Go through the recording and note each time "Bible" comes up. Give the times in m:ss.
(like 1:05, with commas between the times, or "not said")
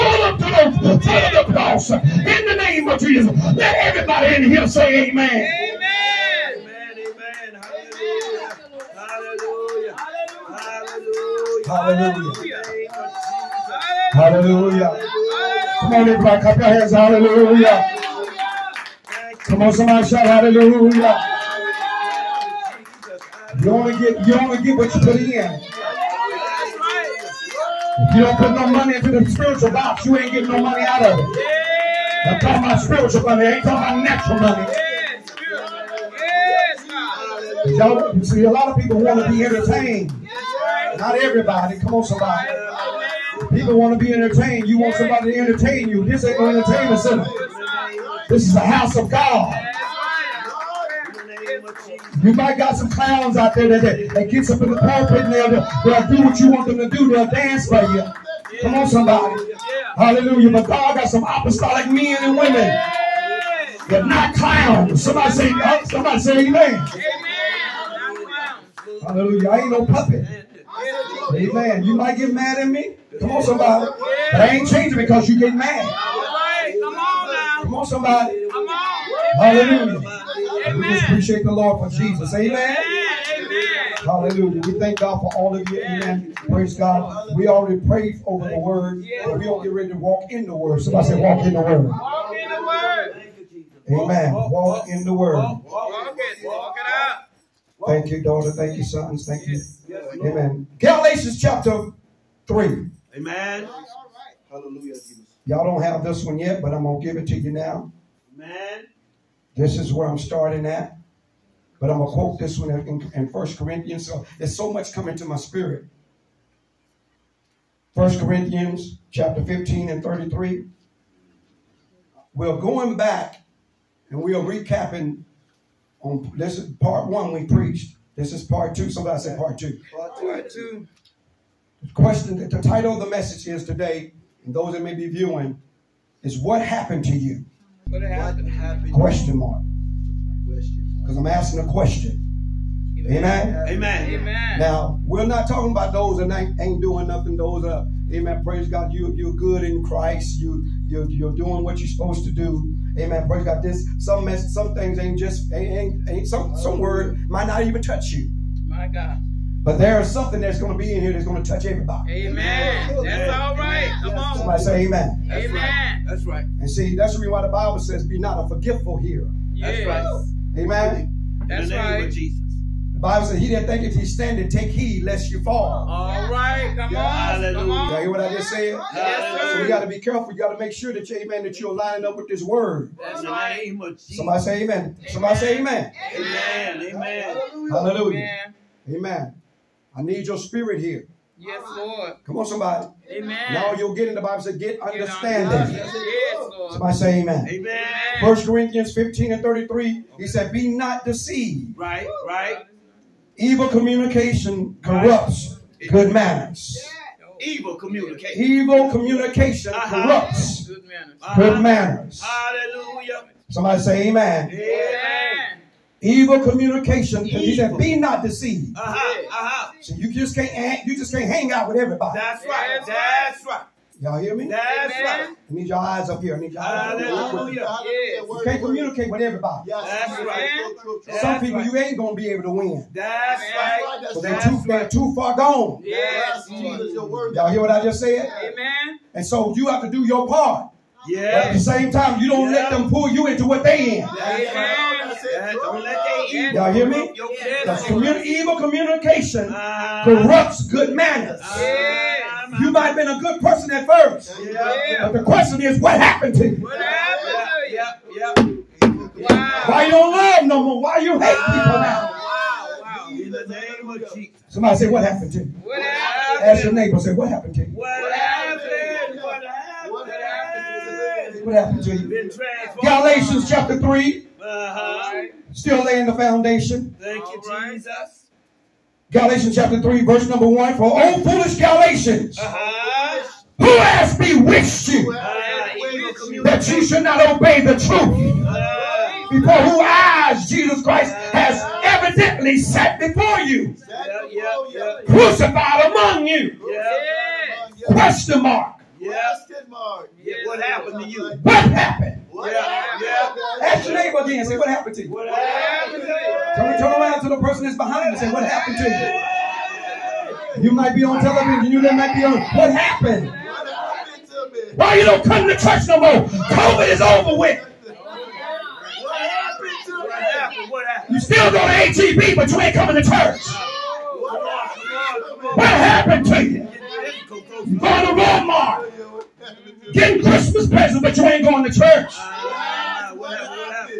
2:47, 2:52, 3:14.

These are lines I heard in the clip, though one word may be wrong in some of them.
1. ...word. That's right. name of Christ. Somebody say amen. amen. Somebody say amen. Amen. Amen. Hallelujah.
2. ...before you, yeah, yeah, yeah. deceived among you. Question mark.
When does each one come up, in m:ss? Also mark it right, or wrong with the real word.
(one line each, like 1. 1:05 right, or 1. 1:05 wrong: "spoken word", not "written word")
1. 3:02 wrong: "Jesus", not "Christ"
2. 4:52 wrong: "crucified", not "deceived".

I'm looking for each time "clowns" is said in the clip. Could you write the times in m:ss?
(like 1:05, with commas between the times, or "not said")
0:52, 1:04.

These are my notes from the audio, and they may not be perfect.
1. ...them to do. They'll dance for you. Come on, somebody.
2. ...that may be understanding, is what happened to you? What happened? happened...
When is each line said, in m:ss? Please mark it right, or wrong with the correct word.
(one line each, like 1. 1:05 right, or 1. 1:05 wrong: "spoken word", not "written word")
1. 0:56 right
2. 2:14 wrong: "viewing", not "understanding".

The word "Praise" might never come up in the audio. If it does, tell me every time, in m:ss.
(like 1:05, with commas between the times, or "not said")
1:26, 2:28, 2:33.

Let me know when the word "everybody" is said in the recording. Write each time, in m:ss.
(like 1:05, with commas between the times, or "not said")
0:03, 0:15, 0:41, 2:41, 3:41, 3:49.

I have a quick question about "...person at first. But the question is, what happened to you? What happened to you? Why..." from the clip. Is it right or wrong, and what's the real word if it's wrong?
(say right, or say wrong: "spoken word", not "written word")
right.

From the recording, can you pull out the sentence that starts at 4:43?
who has bewitched you uh, that you should not obey the truth?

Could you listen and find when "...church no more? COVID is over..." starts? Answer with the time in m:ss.
5:15.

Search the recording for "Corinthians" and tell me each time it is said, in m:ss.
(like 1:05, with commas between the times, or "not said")
1:53, 1:58, 3:18.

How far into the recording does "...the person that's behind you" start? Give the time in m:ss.
5:07.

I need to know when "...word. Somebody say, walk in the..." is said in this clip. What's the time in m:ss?
1:30.